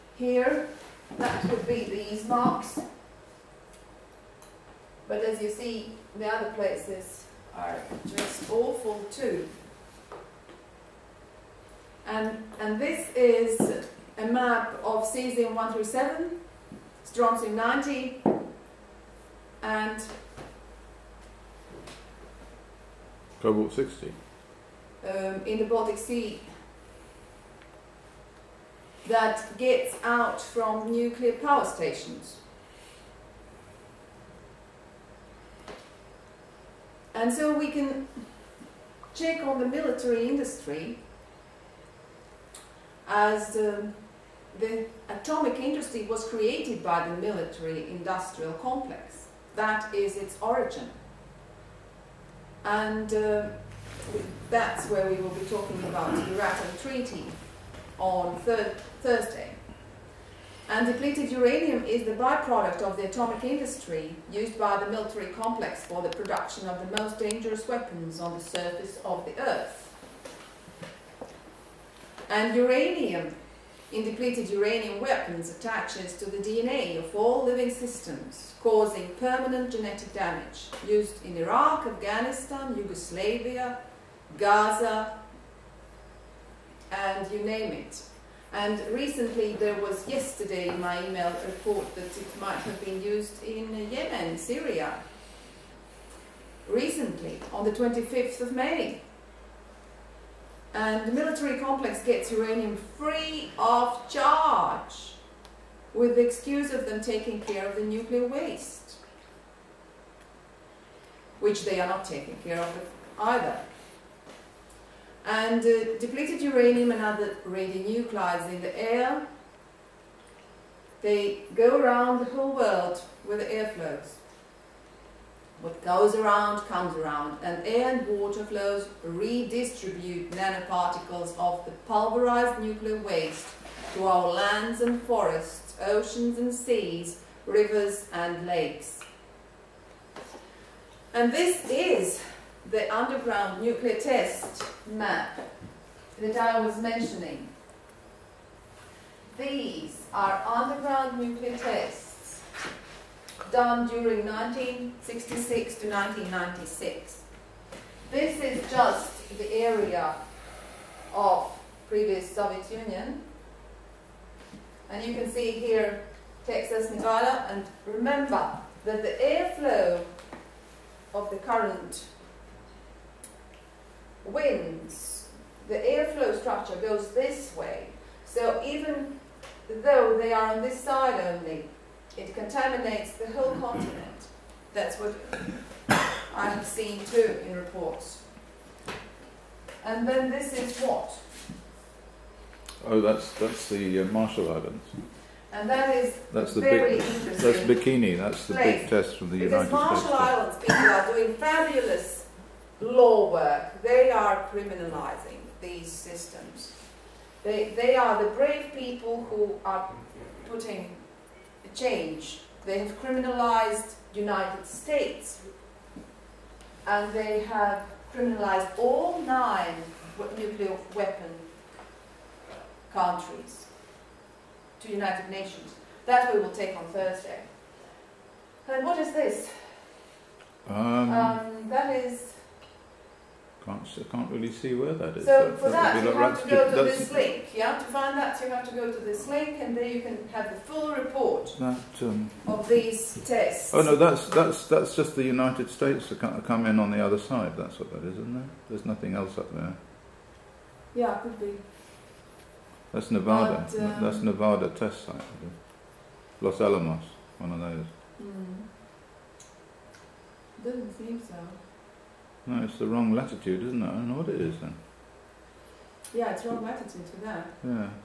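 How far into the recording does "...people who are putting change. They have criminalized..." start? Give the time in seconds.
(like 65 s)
208 s.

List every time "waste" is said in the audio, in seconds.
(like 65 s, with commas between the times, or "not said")
108 s, 132 s.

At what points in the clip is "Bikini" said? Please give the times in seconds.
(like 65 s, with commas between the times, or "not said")
197 s.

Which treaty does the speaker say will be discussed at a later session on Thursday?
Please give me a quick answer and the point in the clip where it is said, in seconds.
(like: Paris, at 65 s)
Euratom Treaty, at 56 s.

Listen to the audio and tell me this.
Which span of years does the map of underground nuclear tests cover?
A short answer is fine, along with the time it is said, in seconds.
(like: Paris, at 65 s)
1966 to 1996, at 154 s.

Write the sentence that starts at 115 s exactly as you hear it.
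And uh, depleted uranium and other radionuclides in the air, they go around the whole world with the airflows.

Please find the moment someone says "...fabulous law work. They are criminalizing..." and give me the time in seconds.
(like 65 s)
201 s.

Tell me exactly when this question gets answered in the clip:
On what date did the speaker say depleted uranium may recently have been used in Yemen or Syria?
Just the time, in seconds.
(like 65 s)
97 s.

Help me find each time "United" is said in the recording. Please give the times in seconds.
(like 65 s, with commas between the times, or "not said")
199 s, 214 s, 224 s, 245 s.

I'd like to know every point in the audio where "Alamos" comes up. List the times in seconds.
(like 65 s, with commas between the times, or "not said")
256 s.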